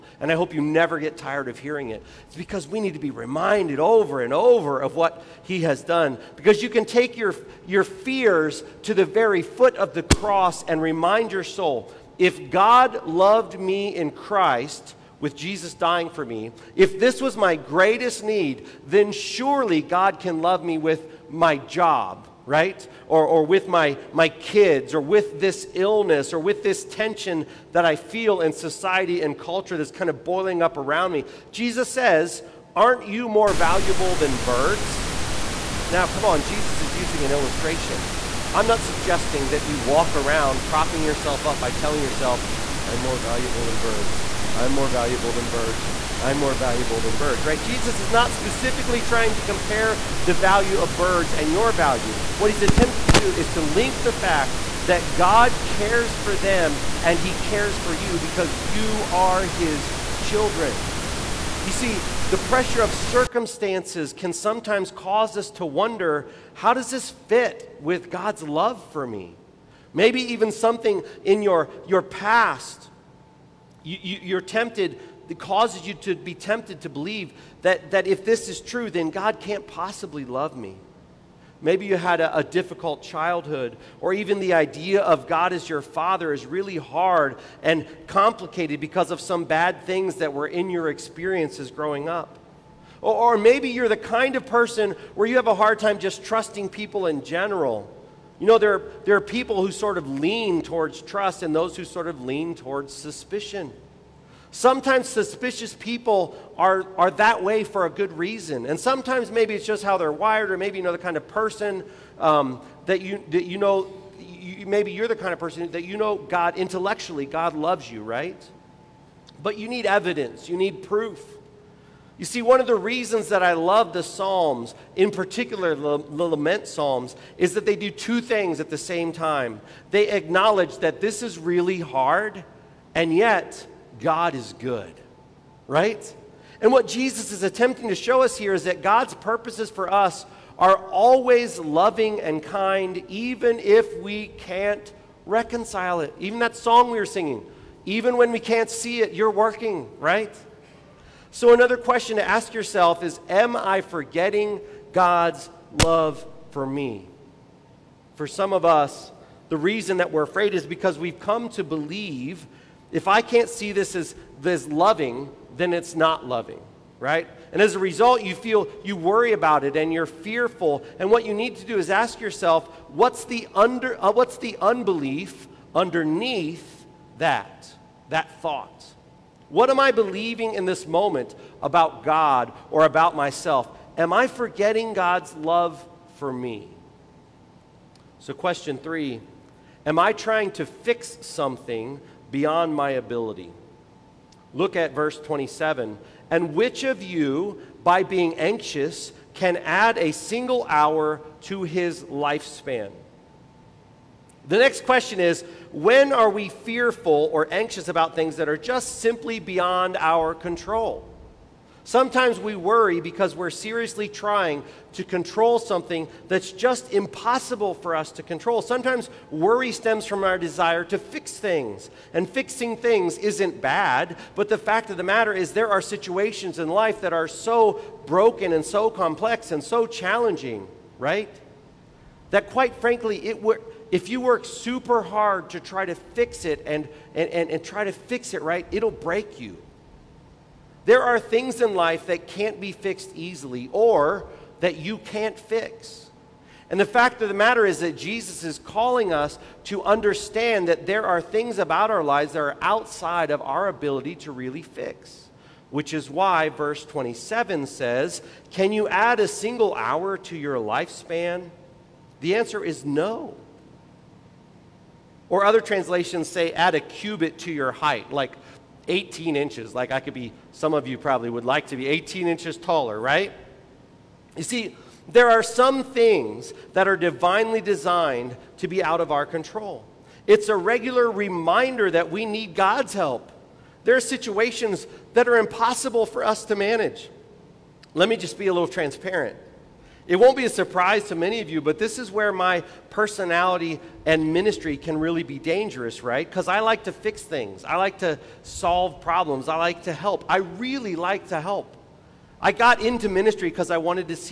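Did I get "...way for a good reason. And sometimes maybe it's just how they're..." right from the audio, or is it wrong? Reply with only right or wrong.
right.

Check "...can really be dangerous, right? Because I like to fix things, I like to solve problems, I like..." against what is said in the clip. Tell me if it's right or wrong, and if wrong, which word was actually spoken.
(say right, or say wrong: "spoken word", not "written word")
right.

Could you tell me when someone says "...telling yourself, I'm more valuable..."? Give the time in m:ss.
0:41.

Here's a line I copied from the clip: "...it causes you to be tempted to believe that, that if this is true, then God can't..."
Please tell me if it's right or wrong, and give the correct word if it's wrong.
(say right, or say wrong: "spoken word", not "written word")
right.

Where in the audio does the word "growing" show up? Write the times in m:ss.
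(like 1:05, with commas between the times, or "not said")
1:31.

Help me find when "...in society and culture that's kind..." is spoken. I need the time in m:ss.
0:28.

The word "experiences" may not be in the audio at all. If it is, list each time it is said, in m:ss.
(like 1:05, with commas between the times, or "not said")
1:30.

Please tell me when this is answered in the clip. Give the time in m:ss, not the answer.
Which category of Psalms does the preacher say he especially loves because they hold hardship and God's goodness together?
2:06.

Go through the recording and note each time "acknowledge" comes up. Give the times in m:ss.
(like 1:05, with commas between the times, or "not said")
2:10.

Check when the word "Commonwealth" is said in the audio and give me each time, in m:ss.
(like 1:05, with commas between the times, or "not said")
not said.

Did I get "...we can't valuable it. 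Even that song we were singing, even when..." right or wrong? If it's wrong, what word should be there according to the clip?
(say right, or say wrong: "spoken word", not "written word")
wrong: "reconcile", not "valuable".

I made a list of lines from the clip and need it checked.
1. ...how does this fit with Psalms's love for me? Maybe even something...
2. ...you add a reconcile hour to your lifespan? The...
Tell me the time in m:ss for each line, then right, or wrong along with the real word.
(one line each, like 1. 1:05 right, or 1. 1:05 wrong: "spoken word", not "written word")
1. 1:06 wrong: "God", not "Psalms"
2. 4:18 wrong: "single", not "reconcile".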